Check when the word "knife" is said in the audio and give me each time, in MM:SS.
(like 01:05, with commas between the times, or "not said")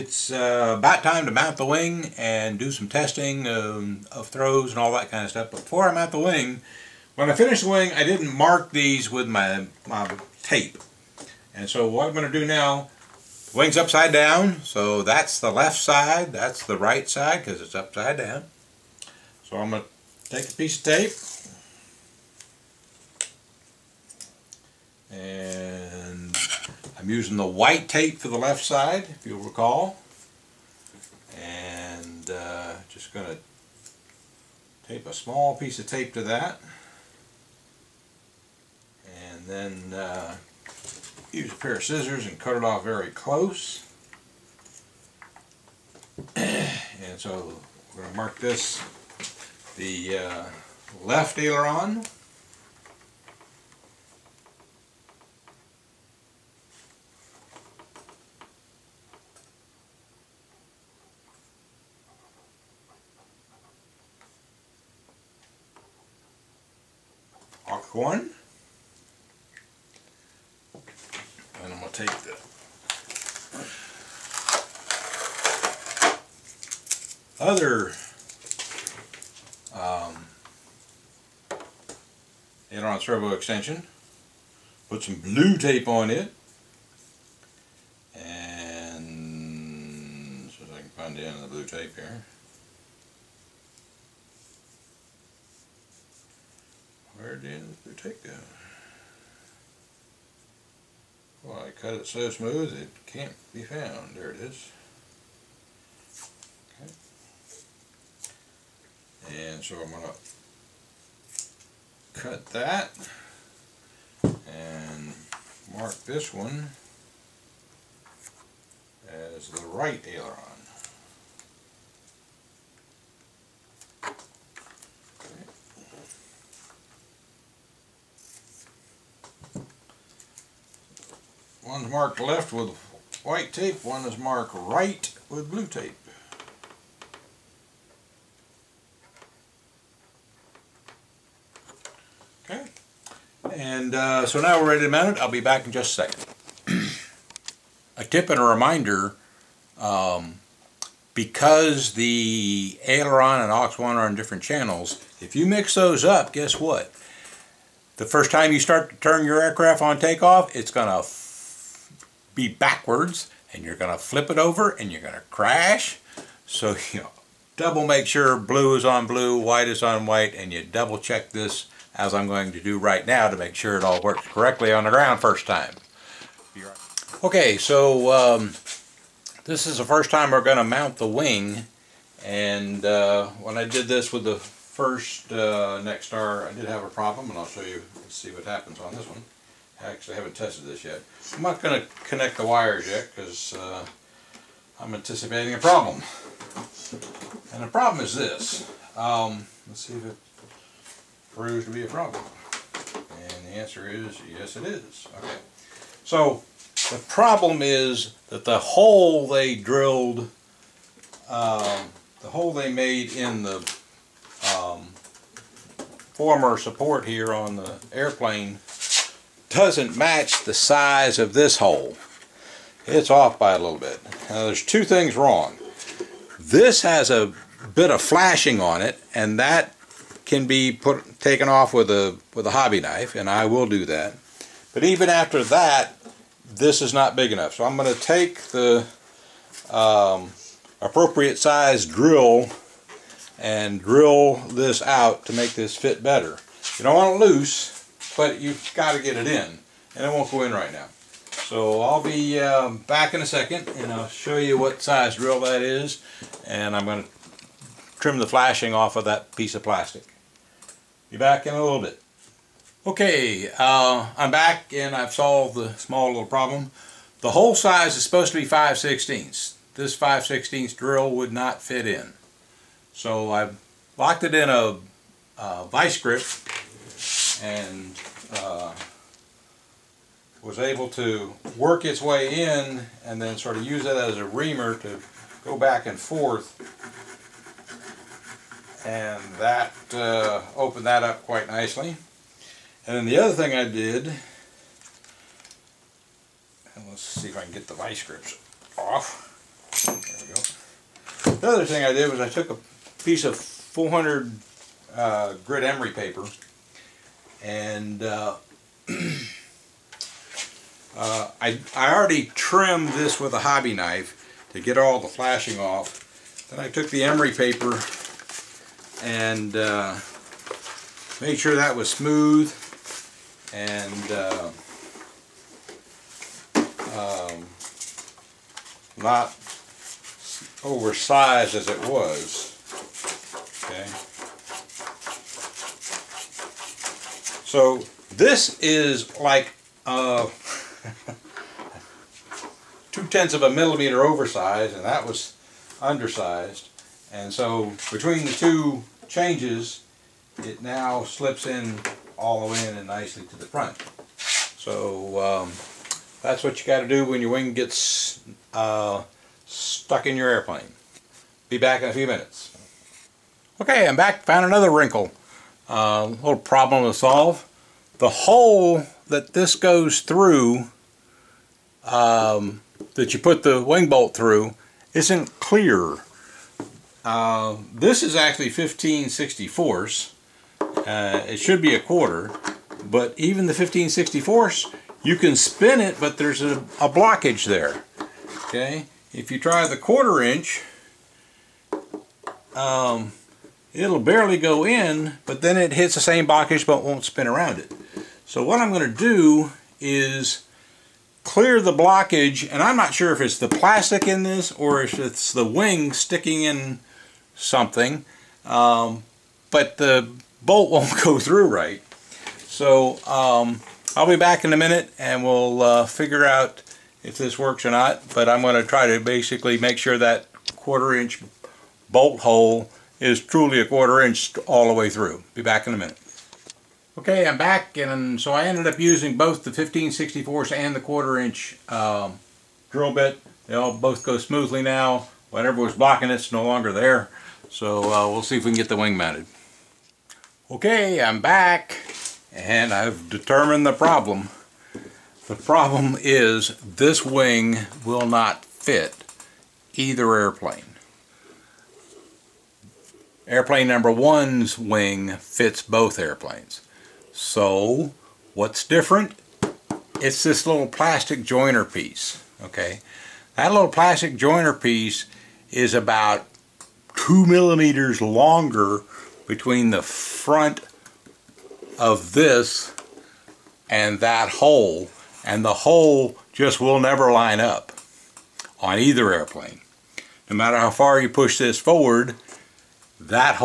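03:52, 05:13.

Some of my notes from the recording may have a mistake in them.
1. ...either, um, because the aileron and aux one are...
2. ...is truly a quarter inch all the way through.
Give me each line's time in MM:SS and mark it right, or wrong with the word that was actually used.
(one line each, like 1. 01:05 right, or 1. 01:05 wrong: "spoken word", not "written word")
1. 02:28 wrong: "reminder", not "either"
2. 07:02 right.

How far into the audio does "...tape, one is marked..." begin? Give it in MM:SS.
02:13.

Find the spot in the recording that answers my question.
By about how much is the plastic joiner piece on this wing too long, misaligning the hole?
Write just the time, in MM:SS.
07:46.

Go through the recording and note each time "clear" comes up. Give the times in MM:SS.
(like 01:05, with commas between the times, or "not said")
06:15, 06:41.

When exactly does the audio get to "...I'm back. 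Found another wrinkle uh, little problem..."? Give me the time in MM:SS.
06:03.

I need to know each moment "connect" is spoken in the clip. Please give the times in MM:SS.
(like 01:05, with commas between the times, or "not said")
03:12.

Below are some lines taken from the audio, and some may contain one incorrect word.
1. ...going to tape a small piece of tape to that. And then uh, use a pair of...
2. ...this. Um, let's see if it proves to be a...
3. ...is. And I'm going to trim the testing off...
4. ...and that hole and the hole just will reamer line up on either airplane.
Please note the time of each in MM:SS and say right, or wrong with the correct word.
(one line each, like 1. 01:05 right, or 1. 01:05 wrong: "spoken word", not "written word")
1. 00:33 right
2. 03:18 right
3. 04:15 wrong: "flashing", not "testing"
4. 07:53 wrong: "never", not "reamer".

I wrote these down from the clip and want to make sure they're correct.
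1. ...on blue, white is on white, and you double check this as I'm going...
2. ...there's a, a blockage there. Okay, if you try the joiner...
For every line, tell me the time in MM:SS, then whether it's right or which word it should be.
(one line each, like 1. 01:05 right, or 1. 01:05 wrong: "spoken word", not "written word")
1. 02:48 right
2. 06:26 wrong: "quarter", not "joiner".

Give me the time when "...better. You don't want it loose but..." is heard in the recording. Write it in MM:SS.
04:06.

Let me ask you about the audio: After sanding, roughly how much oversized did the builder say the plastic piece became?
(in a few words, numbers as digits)
Two tenths of a millimeter.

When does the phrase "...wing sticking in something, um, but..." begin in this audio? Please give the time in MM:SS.
06:45.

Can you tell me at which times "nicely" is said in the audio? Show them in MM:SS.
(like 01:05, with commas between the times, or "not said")
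04:51, 05:52.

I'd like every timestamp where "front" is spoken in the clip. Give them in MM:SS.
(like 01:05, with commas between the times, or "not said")
05:53, 07:49.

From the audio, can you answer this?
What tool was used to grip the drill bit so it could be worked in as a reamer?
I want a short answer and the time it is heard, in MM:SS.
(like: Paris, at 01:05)
Vice grip, at 04:35.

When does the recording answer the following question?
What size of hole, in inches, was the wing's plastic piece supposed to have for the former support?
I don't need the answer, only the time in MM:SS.
04:28.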